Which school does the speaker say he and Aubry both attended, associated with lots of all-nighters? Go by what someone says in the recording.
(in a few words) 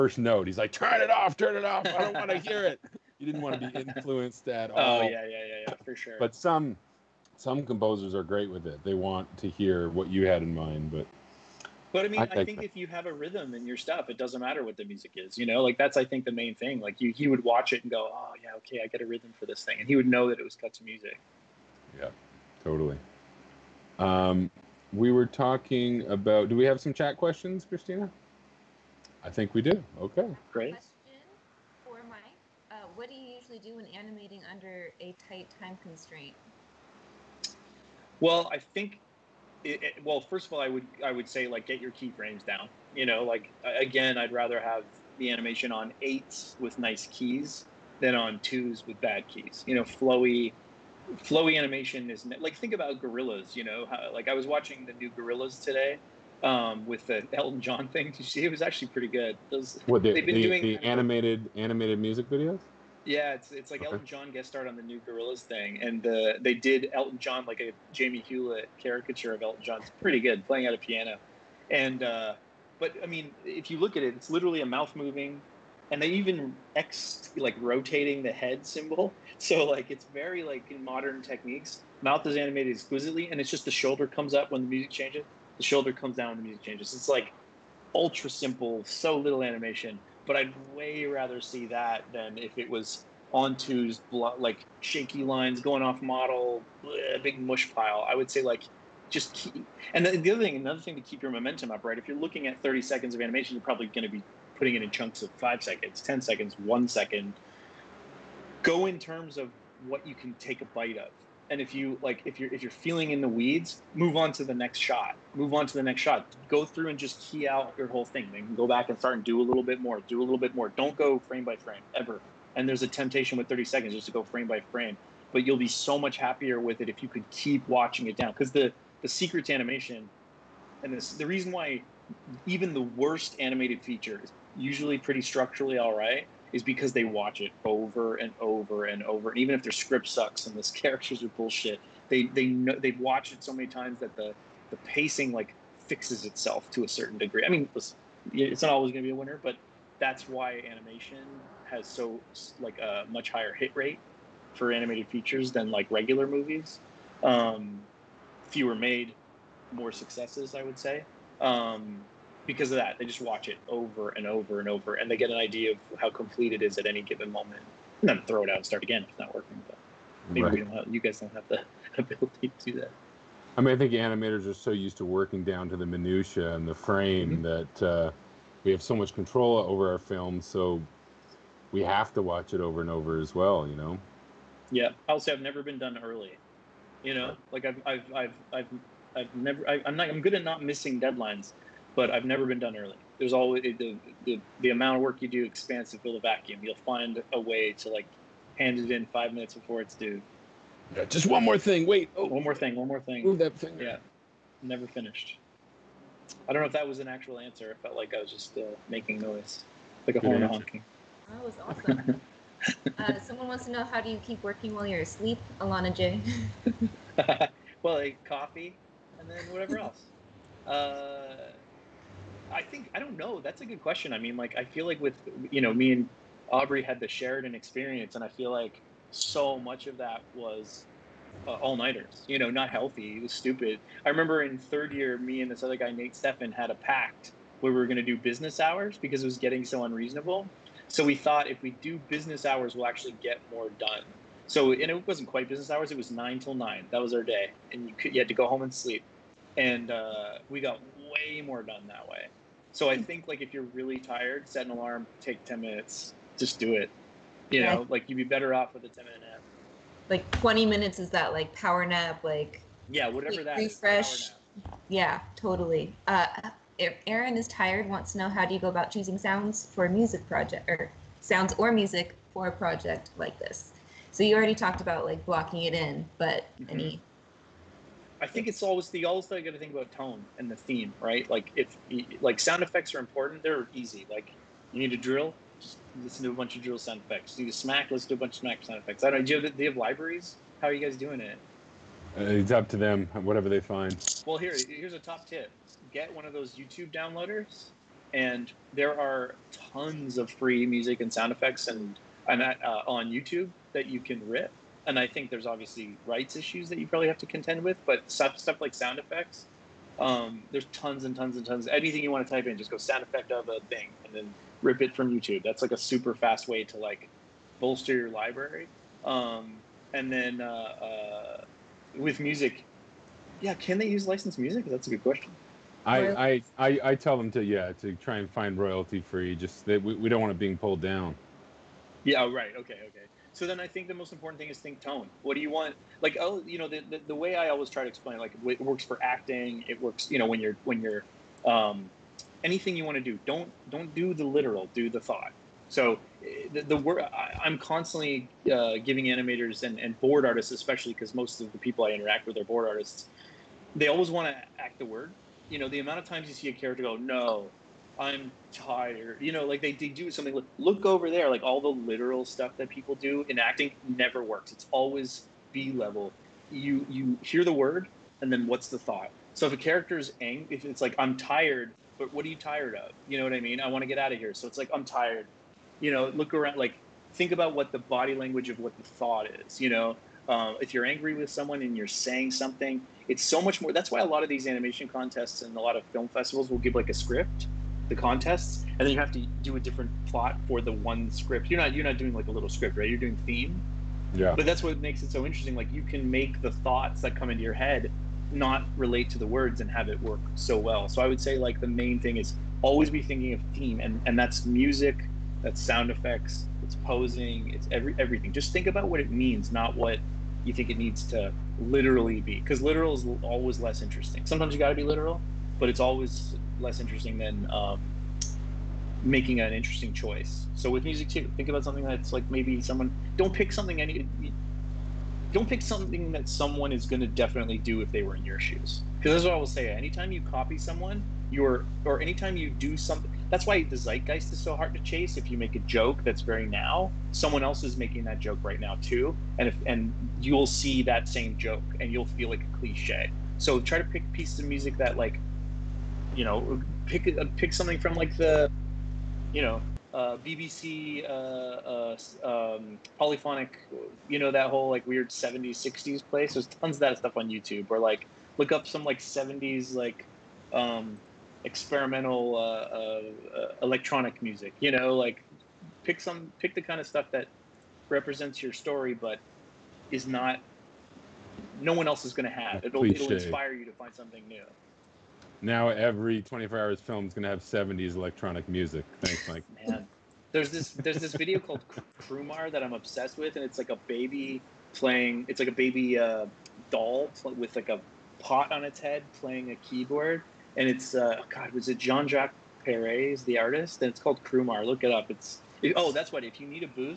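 Sheridan.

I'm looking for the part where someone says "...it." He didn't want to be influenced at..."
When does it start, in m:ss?
0:02.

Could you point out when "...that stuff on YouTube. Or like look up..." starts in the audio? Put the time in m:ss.
7:36.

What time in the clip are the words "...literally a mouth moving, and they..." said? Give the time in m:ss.
1:14.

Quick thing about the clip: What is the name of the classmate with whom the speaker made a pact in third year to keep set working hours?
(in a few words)
Nate Steffen.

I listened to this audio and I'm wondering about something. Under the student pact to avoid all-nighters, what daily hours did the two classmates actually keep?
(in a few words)
9 till 9.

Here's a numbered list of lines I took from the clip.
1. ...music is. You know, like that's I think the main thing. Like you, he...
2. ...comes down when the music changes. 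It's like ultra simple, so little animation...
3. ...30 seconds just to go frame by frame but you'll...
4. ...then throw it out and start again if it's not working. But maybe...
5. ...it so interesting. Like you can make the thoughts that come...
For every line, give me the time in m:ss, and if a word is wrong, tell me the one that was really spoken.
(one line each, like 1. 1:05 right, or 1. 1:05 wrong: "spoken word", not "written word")
1. 0:14 right
2. 1:25 right
3. 2:03 right
4. 2:48 right
5. 6:35 right.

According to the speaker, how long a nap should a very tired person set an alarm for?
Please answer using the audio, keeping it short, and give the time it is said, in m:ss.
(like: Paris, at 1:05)
10 minutes, at 4:15.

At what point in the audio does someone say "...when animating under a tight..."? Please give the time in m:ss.
0:33.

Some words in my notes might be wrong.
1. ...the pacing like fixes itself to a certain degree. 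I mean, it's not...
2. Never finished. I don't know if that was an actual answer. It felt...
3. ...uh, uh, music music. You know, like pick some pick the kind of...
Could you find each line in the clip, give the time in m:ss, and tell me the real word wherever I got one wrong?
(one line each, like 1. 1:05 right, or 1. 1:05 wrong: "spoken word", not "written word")
1. 2:24 right
2. 3:24 right
3. 7:42 wrong: "electronic", not "music".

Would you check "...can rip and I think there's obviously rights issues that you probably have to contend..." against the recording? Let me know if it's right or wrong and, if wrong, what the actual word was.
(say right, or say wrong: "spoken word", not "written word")
right.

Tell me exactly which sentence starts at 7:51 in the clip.
No one else is going to have.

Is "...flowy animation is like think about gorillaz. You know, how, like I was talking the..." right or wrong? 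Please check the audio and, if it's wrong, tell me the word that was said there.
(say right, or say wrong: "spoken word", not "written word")
wrong: "watching", not "talking".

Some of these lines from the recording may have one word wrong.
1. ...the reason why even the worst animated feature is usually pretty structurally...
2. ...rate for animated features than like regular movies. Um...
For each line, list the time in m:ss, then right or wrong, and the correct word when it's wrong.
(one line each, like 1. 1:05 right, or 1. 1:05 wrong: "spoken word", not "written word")
1. 2:11 right
2. 2:33 right.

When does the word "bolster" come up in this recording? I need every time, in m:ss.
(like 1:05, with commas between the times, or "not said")
5:17.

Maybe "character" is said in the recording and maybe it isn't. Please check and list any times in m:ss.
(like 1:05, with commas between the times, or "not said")
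2:20, 5:56, 6:09.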